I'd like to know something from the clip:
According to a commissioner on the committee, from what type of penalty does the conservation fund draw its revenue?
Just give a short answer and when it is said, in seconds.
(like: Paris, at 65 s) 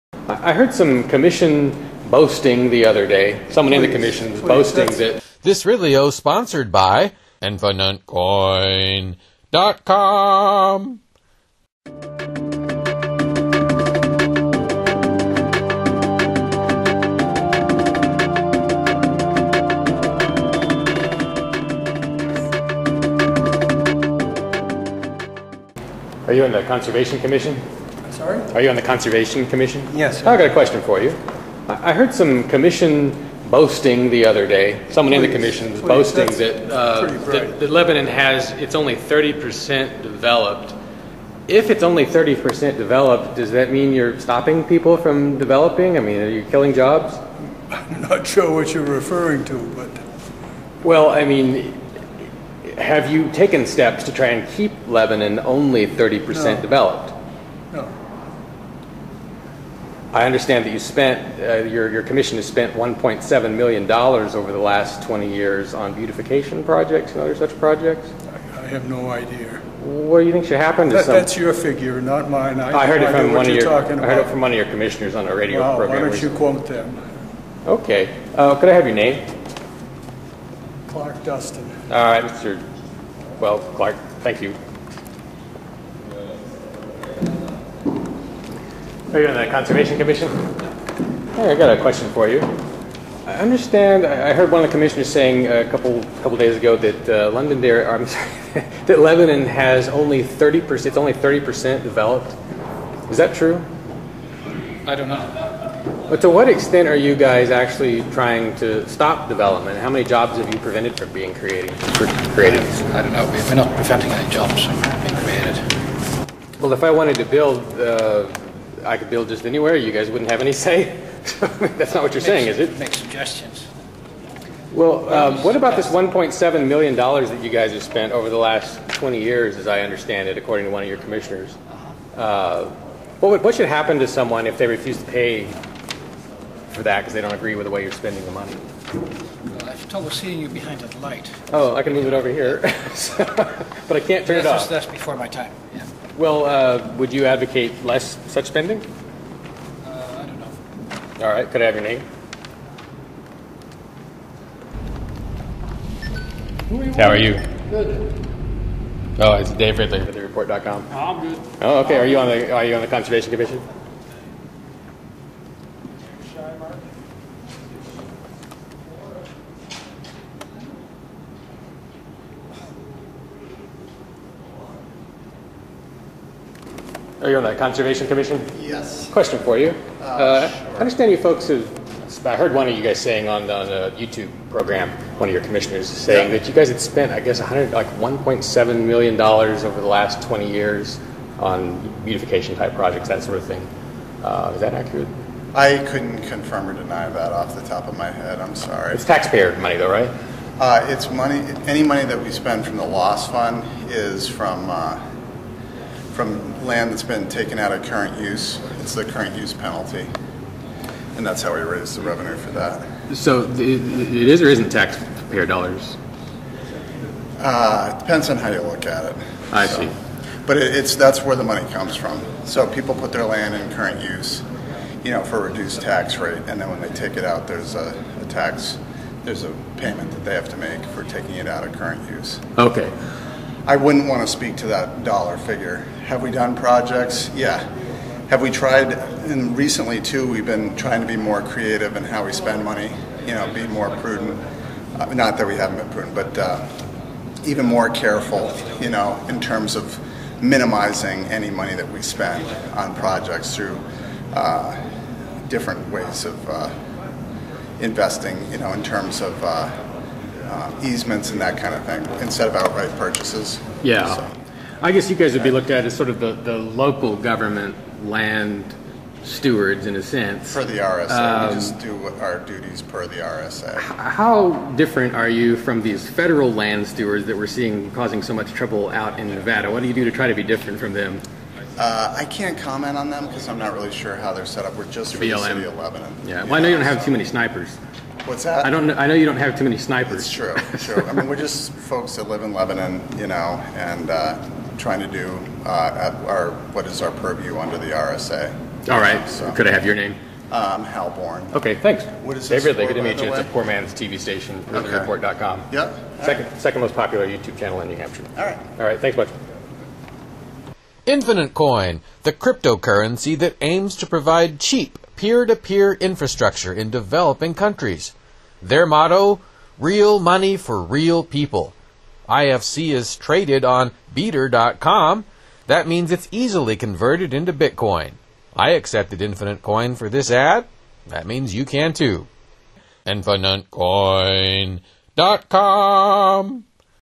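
current use penalty, at 209 s.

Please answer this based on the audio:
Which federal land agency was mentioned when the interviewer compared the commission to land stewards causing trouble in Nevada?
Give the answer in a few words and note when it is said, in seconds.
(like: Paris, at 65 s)
BLM, at 285 s.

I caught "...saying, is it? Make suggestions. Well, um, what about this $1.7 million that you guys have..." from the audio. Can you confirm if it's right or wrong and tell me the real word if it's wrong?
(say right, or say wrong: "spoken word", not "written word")
right.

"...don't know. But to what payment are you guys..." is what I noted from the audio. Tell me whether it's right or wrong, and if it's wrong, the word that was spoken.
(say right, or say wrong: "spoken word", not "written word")
wrong: "extent", not "payment".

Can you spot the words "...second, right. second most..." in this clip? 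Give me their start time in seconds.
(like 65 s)
306 s.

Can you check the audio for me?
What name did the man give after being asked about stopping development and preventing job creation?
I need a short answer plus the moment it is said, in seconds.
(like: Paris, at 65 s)
Clark Dustin, at 80 s.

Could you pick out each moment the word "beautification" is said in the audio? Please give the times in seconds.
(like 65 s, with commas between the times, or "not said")
65 s, 192 s.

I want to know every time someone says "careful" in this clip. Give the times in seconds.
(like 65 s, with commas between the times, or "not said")
247 s.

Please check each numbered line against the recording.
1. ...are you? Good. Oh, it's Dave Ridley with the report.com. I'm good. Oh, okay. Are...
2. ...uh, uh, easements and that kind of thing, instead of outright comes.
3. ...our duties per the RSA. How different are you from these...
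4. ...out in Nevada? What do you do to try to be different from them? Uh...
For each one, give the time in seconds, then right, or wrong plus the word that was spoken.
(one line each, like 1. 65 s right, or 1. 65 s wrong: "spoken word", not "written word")
1. 157 s right
2. 259 s wrong: "purchases", not "comes"
3. 272 s right
4. 278 s right.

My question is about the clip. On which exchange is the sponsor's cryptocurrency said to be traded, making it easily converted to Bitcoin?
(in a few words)
Bter.com.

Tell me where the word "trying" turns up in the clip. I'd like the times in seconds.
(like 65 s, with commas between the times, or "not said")
108 s, 240 s, 294 s.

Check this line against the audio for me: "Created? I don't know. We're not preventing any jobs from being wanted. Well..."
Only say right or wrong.
wrong.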